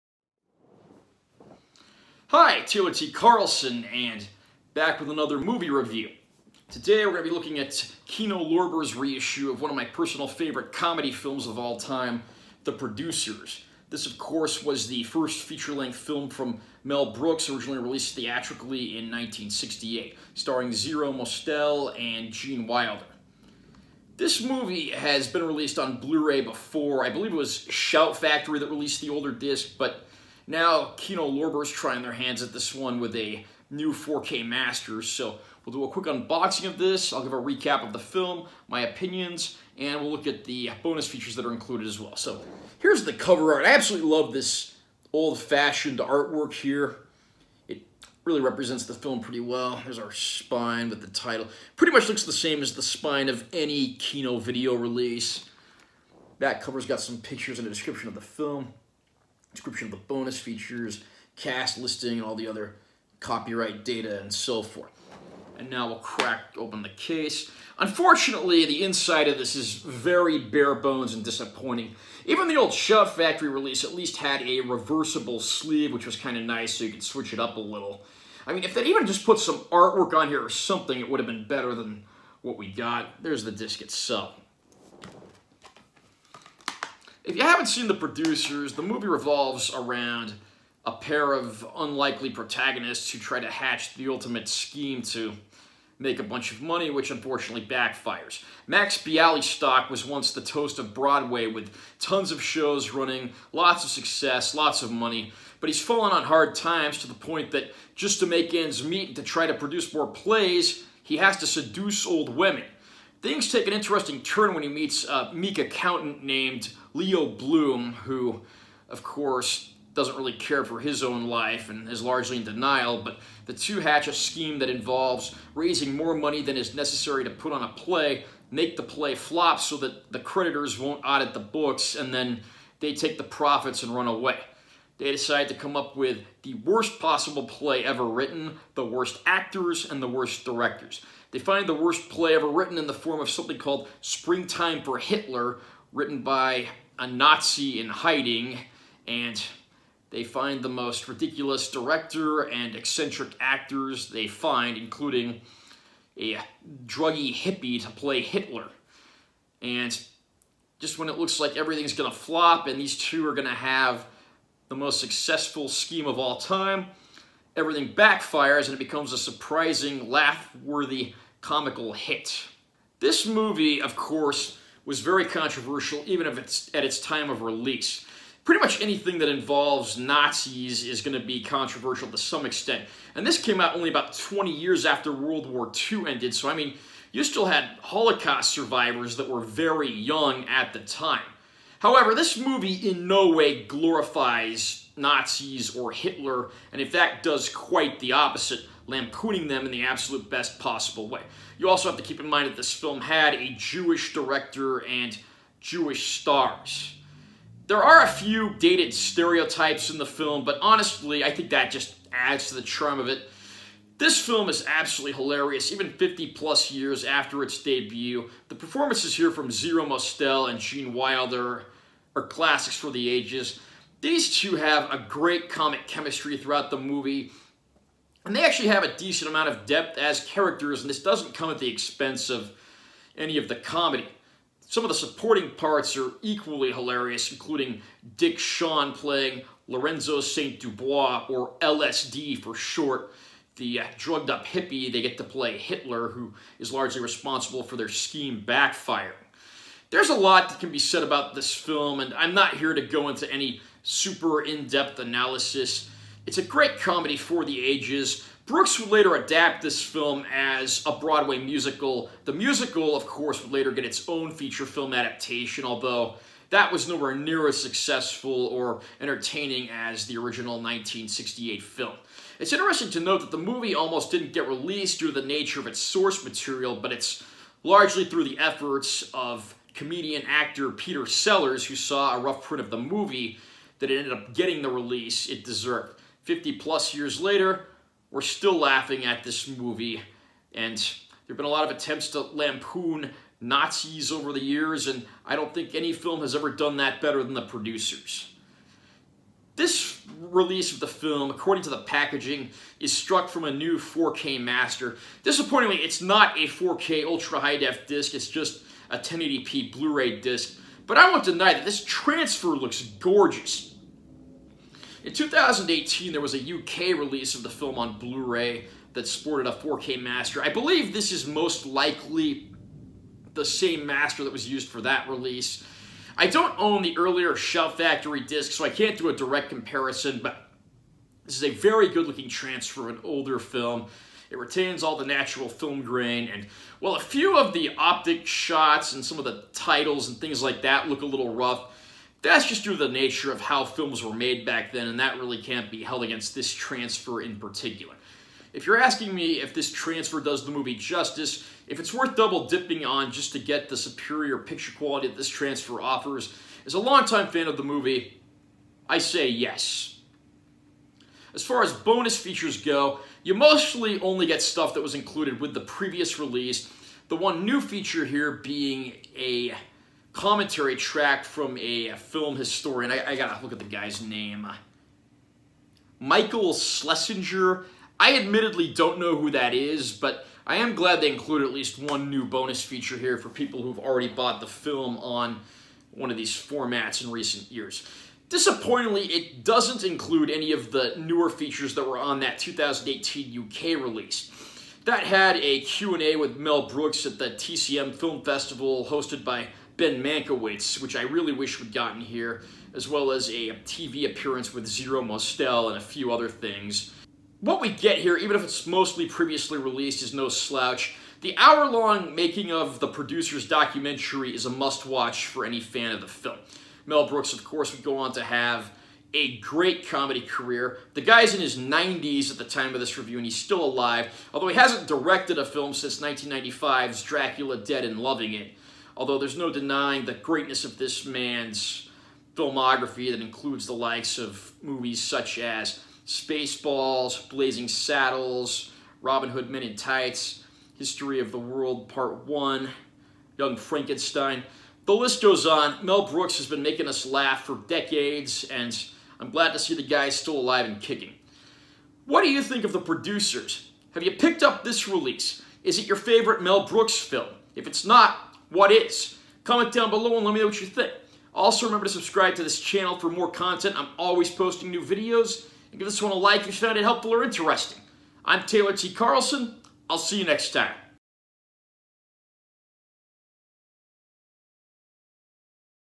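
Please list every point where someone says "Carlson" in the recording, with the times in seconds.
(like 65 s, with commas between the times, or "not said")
3 s, 468 s.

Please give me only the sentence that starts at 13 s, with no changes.
This, of course, was the first feature-length film from Mel Brooks, originally released theatrically in 1968, starring Zero Mostel and Gene Wilder.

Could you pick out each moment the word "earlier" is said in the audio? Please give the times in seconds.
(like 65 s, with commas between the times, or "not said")
326 s.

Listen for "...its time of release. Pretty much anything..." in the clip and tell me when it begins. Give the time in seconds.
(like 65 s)
176 s.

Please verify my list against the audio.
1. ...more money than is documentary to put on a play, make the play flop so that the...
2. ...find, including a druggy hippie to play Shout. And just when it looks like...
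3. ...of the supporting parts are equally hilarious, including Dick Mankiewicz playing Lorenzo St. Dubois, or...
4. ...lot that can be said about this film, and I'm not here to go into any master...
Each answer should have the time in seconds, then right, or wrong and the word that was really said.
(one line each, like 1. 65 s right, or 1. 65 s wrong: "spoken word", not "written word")
1. 125 s wrong: "necessary", not "documentary"
2. 154 s wrong: "Hitler", not "Shout"
3. 234 s wrong: "Shawn", not "Mankiewicz"
4. 250 s wrong: "super", not "master".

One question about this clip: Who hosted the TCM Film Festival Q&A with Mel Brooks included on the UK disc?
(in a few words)
Ben Mankiewicz.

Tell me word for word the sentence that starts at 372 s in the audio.
I, I gotta look at the guy's name.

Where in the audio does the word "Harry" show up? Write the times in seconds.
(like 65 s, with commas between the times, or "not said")
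not said.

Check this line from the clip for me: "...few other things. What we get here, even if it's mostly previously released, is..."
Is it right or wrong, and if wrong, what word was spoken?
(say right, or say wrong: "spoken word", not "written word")
right.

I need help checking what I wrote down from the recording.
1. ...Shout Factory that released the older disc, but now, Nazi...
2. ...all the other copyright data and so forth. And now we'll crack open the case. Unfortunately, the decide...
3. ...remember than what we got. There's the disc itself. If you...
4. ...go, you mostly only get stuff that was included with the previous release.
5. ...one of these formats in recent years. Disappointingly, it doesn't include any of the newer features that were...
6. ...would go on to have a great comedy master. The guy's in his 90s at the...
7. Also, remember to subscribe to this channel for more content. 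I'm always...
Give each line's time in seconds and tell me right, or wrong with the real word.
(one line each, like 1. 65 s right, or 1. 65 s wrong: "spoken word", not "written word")
1. 27 s wrong: "Kino", not "Nazi"
2. 62 s wrong: "inside", not "decide"
3. 81 s wrong: "better", not "remember"
4. 362 s right
5. 385 s right
6. 417 s wrong: "career", not "master"
7. 461 s right.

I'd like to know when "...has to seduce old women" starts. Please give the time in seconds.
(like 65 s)
111 s.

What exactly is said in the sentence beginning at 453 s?
Have you picked up this release?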